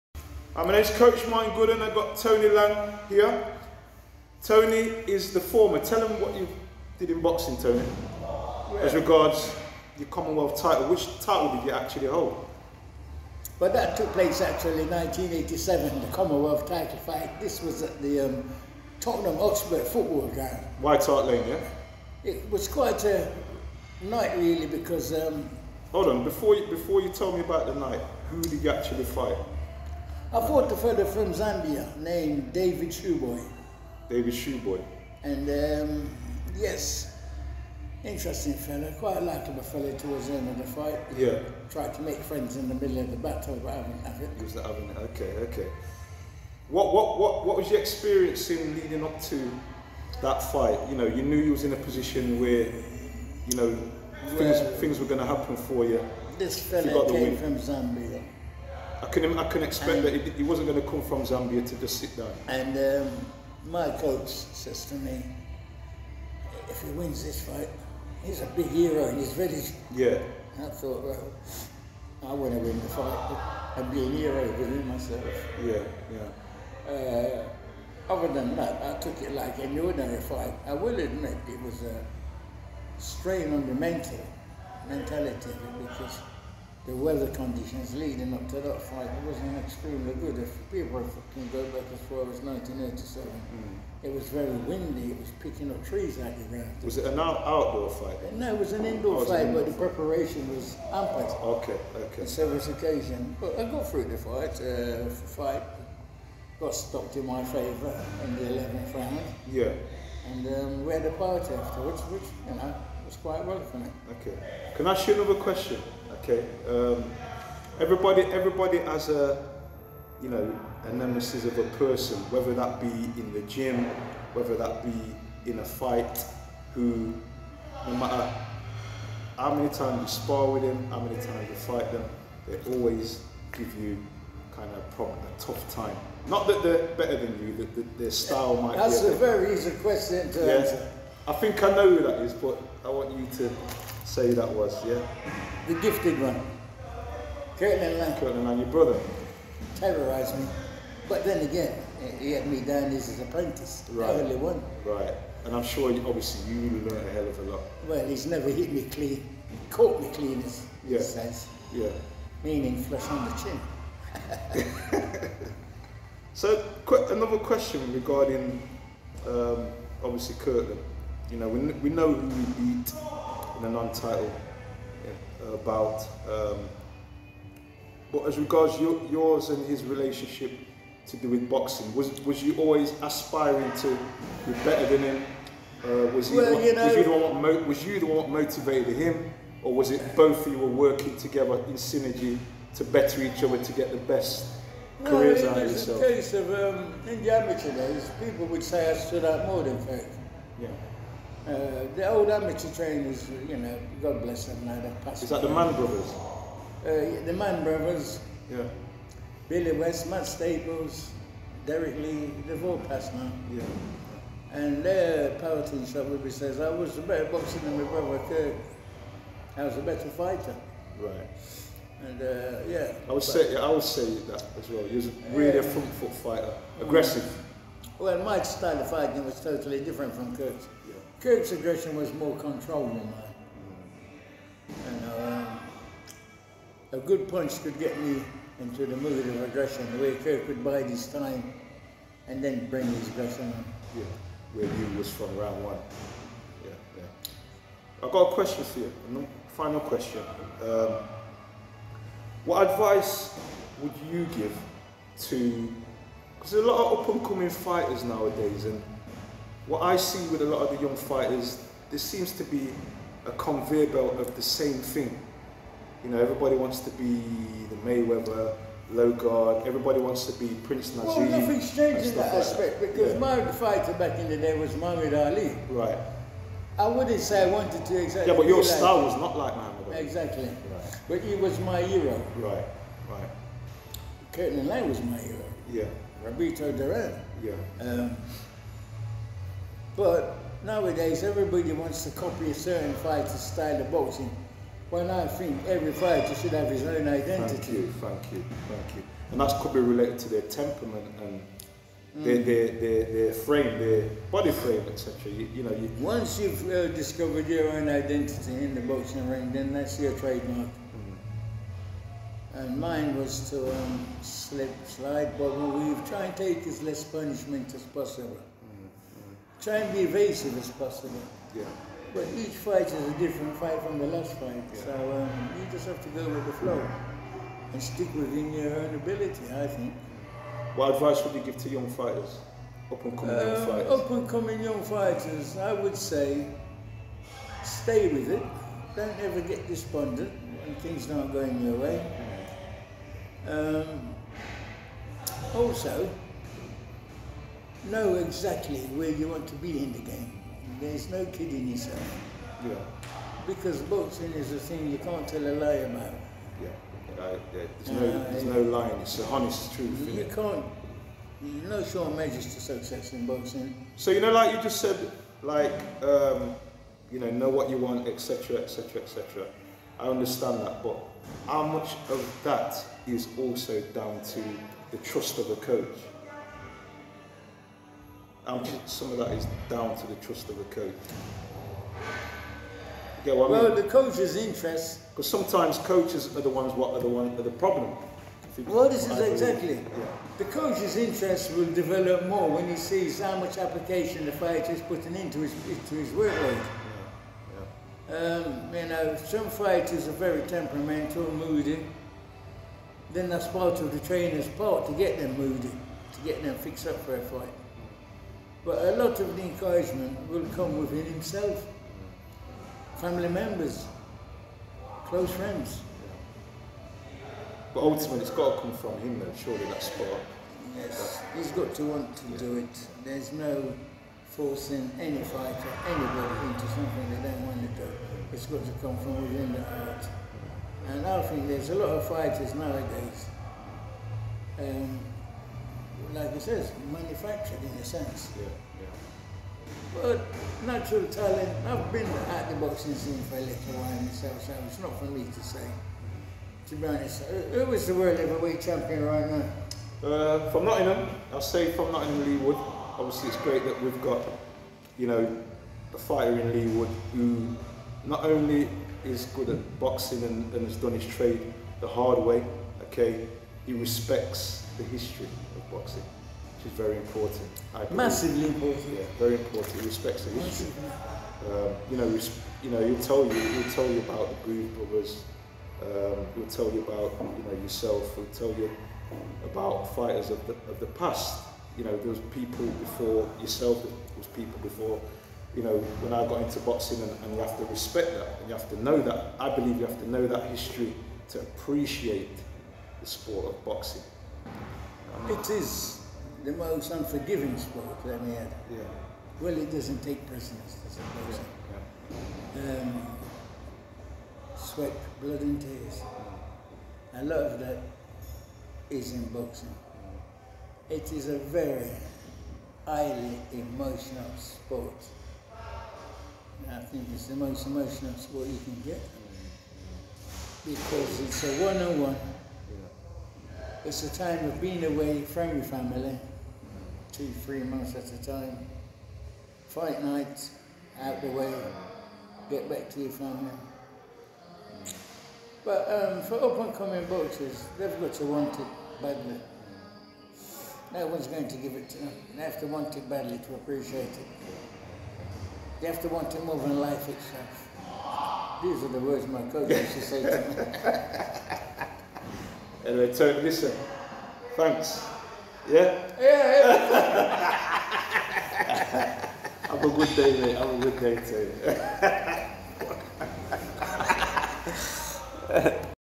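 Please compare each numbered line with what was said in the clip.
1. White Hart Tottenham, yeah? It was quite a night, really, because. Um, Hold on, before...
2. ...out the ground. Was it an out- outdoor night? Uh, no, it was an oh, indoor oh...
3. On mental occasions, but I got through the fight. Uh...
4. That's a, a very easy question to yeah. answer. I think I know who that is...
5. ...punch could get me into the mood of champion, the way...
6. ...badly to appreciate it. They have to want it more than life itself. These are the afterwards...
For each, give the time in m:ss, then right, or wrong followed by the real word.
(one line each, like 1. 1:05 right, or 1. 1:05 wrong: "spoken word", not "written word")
1. 0:20 wrong: "Lane", not "Tottenham"
2. 1:36 wrong: "fight", not "night"
3. 1:42 wrong: "several", not "mental"
4. 2:19 right
5. 3:57 wrong: "aggression", not "champion"
6. 9:03 wrong: "words", not "afterwards".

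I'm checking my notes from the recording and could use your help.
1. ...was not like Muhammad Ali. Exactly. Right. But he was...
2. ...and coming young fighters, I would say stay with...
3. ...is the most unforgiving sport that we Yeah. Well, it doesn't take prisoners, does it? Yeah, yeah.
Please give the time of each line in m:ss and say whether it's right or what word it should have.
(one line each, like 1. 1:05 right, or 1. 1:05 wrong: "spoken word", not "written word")
1. 4:39 right
2. 5:34 right
3. 8:15 right.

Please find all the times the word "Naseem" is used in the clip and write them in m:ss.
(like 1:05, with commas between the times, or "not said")
4:30.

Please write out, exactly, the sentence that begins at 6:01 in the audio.
no sure measures to success in boxing.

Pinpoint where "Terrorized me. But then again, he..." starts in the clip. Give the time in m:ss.
2:29.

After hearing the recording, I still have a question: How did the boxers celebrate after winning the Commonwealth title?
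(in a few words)
a party.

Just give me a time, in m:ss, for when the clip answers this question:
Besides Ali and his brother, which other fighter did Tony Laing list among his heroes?
4:46.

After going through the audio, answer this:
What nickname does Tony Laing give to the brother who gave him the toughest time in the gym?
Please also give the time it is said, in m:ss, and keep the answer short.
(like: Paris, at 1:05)
The gifted one, at 2:25.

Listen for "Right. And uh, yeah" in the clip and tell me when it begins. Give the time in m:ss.
3:40.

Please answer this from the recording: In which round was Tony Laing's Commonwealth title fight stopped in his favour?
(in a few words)
11th.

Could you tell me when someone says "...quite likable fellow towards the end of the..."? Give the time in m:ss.
0:38.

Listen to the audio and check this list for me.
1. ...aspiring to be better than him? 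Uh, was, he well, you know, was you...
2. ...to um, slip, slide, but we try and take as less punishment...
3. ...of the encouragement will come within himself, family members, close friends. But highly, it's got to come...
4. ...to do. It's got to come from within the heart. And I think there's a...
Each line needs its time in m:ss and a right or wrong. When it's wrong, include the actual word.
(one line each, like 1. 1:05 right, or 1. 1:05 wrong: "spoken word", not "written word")
1. 3:03 right
2. 5:13 right
3. 6:49 wrong: "ultimately", not "highly"
4. 7:07 right.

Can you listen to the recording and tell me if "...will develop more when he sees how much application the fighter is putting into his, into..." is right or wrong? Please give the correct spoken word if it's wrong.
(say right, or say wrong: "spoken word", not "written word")
right.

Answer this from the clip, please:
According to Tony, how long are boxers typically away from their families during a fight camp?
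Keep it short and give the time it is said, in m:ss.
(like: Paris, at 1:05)
two, three months, at 8:47.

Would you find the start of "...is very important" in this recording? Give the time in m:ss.
7:46.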